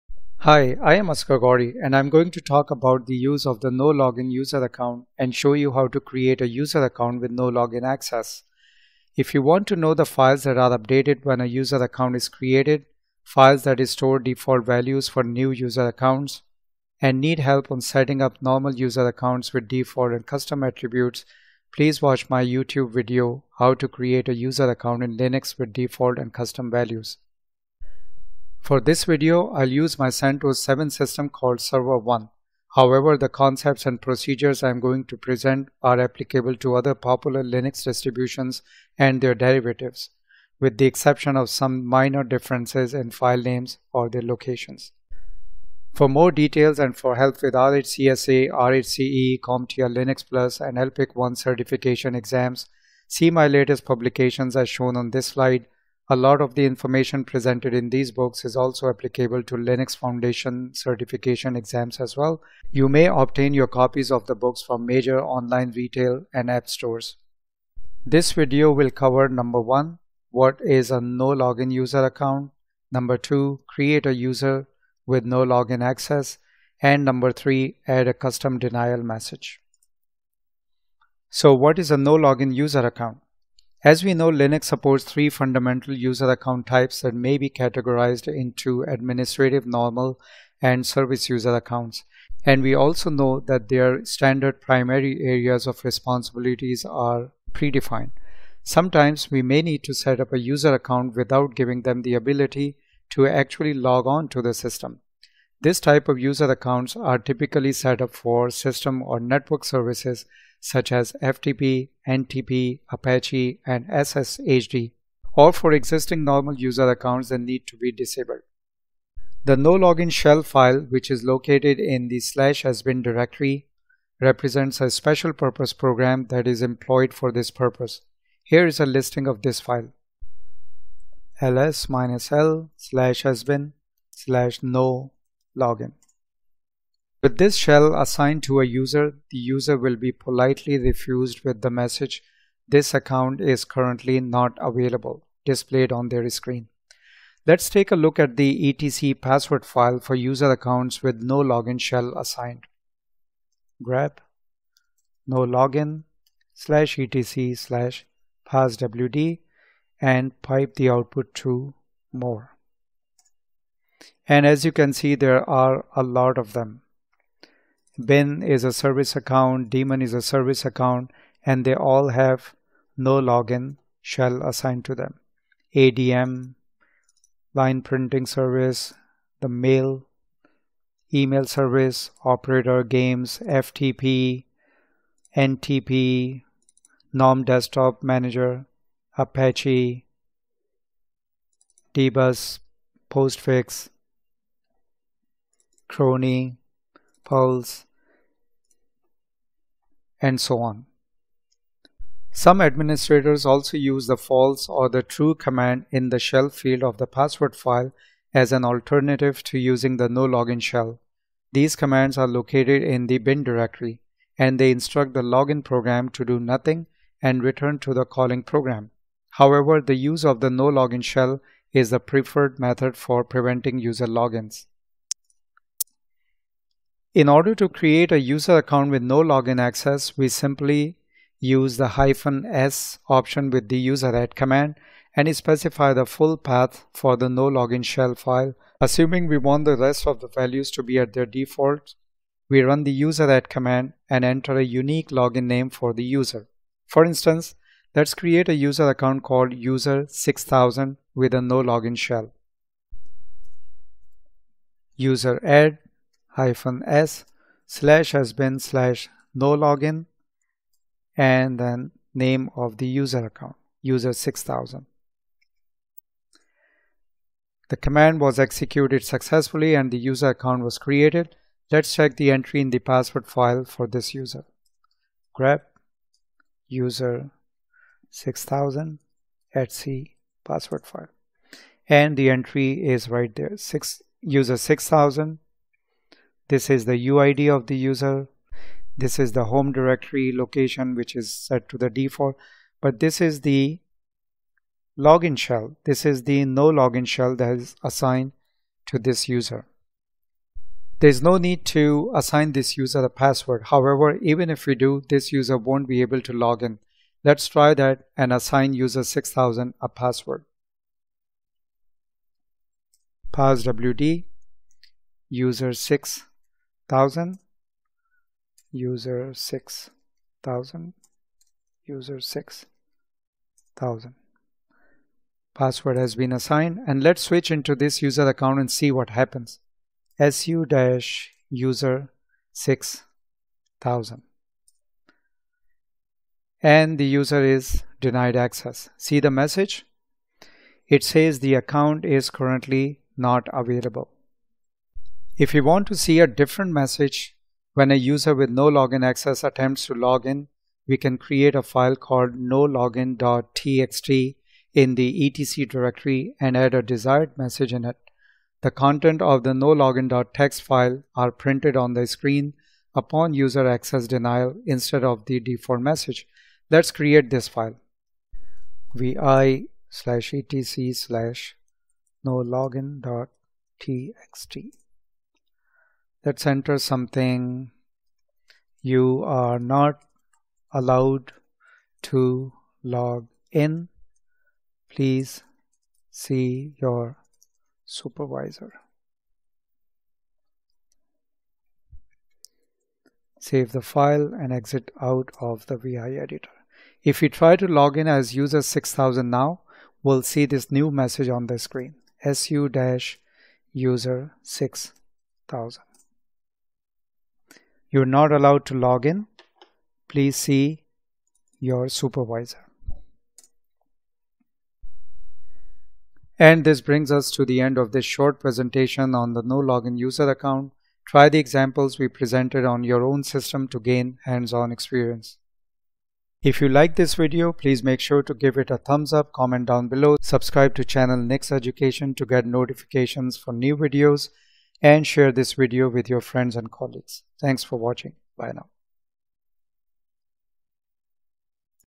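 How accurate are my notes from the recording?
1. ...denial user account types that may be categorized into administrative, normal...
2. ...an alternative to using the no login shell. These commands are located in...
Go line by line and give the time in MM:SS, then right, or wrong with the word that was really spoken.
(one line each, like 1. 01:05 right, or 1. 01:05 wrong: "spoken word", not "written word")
1. 01:25 wrong: "fundamental", not "denial"
2. 03:28 right.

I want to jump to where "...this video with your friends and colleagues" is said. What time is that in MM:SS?
07:15.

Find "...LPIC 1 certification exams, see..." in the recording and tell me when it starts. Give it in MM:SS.
00:50.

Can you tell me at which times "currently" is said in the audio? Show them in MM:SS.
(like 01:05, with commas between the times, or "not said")
02:23, 05:42.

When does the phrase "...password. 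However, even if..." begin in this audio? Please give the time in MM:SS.
05:03.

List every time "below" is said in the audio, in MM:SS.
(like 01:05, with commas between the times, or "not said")
07:09.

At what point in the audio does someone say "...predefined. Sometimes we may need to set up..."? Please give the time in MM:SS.
01:37.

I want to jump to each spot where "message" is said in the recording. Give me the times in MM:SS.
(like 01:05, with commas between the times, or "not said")
01:19, 02:21, 05:39, 05:46, 05:57, 06:05, 06:40.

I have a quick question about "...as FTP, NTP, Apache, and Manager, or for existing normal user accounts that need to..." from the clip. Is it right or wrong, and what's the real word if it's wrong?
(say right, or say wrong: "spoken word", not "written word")
wrong: "SSHD", not "Manager".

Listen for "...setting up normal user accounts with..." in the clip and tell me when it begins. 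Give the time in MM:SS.
00:17.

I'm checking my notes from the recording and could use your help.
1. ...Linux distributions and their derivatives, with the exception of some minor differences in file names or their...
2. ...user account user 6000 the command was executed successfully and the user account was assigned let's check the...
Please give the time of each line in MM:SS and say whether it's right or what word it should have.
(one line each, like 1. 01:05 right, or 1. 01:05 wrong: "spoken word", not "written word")
1. 00:37 right
2. 04:22 wrong: "created", not "assigned".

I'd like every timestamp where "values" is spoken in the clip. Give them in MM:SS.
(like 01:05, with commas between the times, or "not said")
00:14, 00:26, 04:00.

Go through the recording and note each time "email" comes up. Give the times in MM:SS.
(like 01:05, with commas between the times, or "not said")
03:01.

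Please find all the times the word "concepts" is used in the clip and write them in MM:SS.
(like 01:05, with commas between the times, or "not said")
00:33.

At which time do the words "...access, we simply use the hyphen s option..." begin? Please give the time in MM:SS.
03:49.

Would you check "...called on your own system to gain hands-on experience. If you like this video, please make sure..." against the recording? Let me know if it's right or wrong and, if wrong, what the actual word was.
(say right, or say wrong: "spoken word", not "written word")
wrong: "presented", not "called".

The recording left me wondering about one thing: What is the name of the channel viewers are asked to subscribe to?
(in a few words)
Nix Education.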